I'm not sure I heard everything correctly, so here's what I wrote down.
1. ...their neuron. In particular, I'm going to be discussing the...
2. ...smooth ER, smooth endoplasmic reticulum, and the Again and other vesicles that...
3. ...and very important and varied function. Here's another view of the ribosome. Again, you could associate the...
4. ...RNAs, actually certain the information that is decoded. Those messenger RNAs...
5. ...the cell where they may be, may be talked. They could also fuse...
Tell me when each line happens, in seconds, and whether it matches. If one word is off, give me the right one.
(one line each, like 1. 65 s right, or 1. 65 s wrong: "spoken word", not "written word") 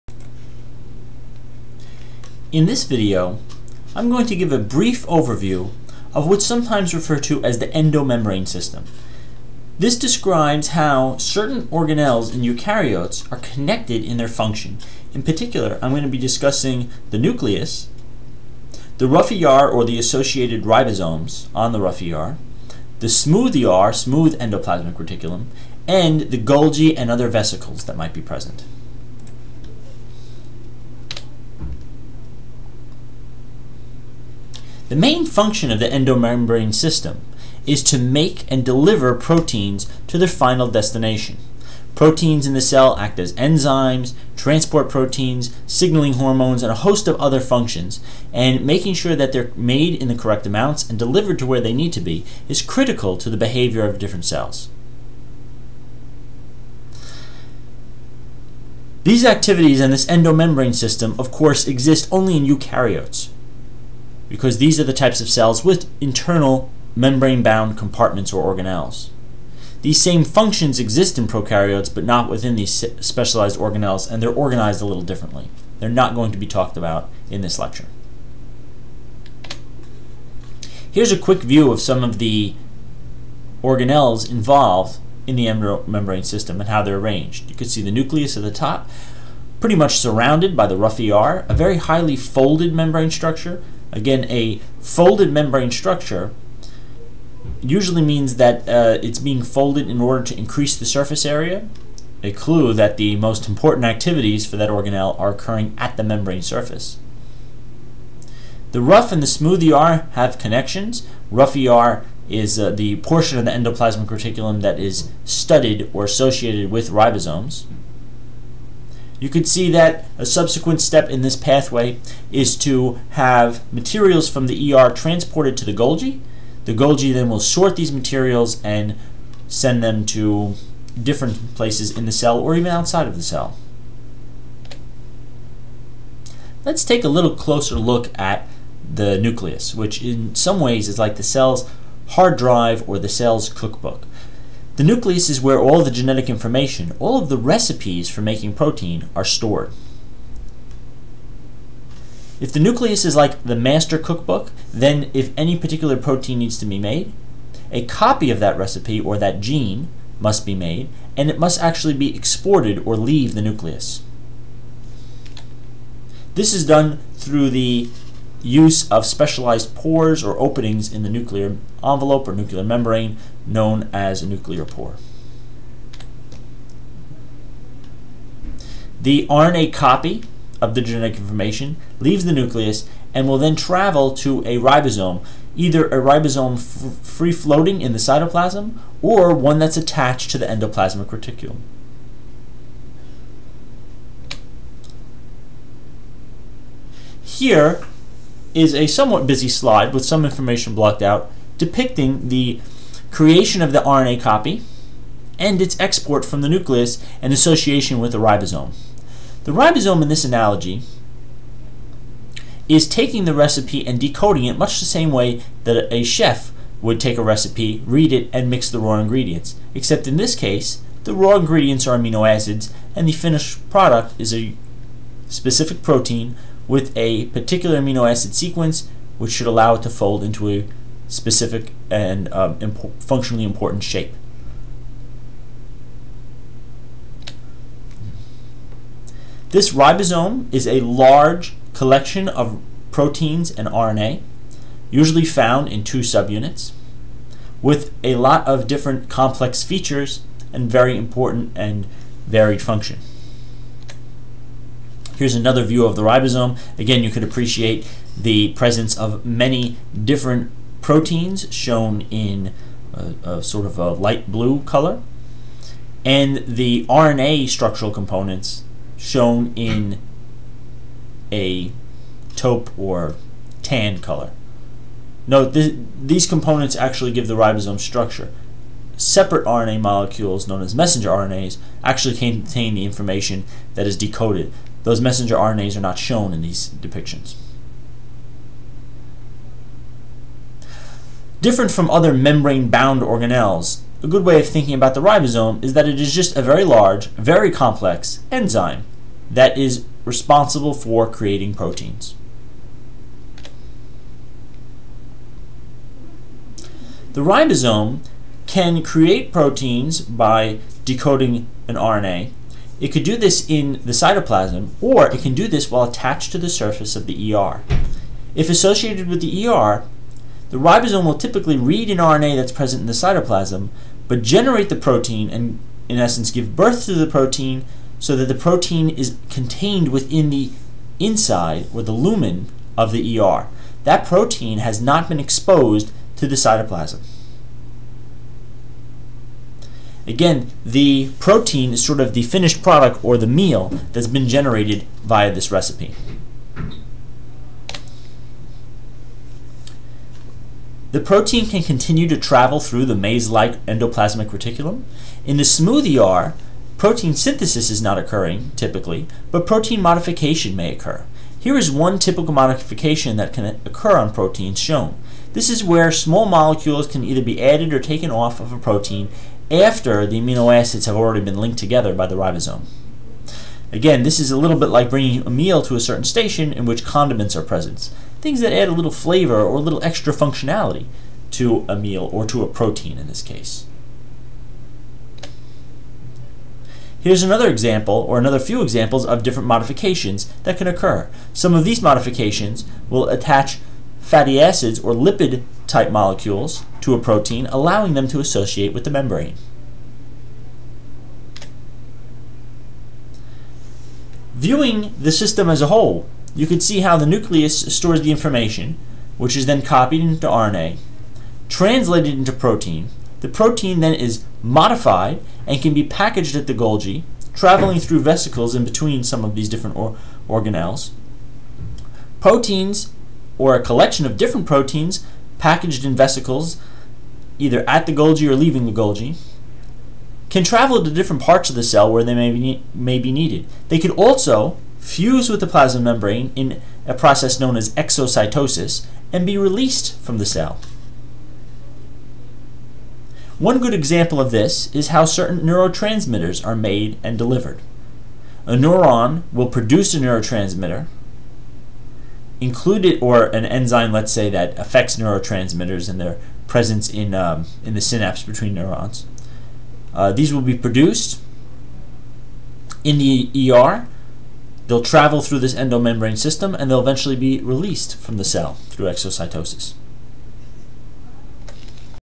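1. 14 s wrong: "function", not "neuron"
2. 23 s wrong: "Golgi", not "Again"
3. 250 s wrong: "appreciate", not "associate"
4. 281 s wrong: "contain", not "certain"
5. 431 s wrong: "needed", not "talked".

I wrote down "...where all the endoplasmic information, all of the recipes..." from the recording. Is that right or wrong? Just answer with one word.
wrong.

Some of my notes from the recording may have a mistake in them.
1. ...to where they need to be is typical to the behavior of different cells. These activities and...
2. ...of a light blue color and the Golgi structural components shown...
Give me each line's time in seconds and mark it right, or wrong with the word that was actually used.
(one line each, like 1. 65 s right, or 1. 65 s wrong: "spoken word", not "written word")
1. 51 s wrong: "critical", not "typical"
2. 263 s wrong: "RNA", not "Golgi".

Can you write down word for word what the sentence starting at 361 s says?
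Here is one typical modification that can occur on proteins shown.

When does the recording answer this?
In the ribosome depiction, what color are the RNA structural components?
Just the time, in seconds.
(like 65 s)
272 s.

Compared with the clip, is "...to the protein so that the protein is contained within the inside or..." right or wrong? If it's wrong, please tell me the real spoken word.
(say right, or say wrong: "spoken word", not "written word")
right.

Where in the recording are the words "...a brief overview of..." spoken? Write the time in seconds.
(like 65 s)
4 s.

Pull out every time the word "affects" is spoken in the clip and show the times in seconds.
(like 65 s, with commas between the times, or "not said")
454 s.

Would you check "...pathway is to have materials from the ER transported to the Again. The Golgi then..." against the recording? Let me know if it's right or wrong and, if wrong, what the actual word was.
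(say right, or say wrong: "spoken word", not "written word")
wrong: "Golgi", not "Again".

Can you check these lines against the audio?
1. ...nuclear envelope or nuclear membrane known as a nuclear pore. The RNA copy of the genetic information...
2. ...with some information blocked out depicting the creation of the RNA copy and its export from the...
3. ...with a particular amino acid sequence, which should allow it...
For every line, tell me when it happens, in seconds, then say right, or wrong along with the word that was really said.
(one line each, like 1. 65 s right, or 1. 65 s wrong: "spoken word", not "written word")
1. 171 s right
2. 199 s right
3. 226 s right.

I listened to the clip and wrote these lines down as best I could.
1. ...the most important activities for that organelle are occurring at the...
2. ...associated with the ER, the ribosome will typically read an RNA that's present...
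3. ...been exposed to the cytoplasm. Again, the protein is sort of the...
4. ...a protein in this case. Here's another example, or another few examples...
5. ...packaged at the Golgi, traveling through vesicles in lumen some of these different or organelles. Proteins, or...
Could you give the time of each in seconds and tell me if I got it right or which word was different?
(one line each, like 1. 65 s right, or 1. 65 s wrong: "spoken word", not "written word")
1. 102 s right
2. 318 s right
3. 335 s right
4. 382 s right
5. 415 s wrong: "between", not "lumen".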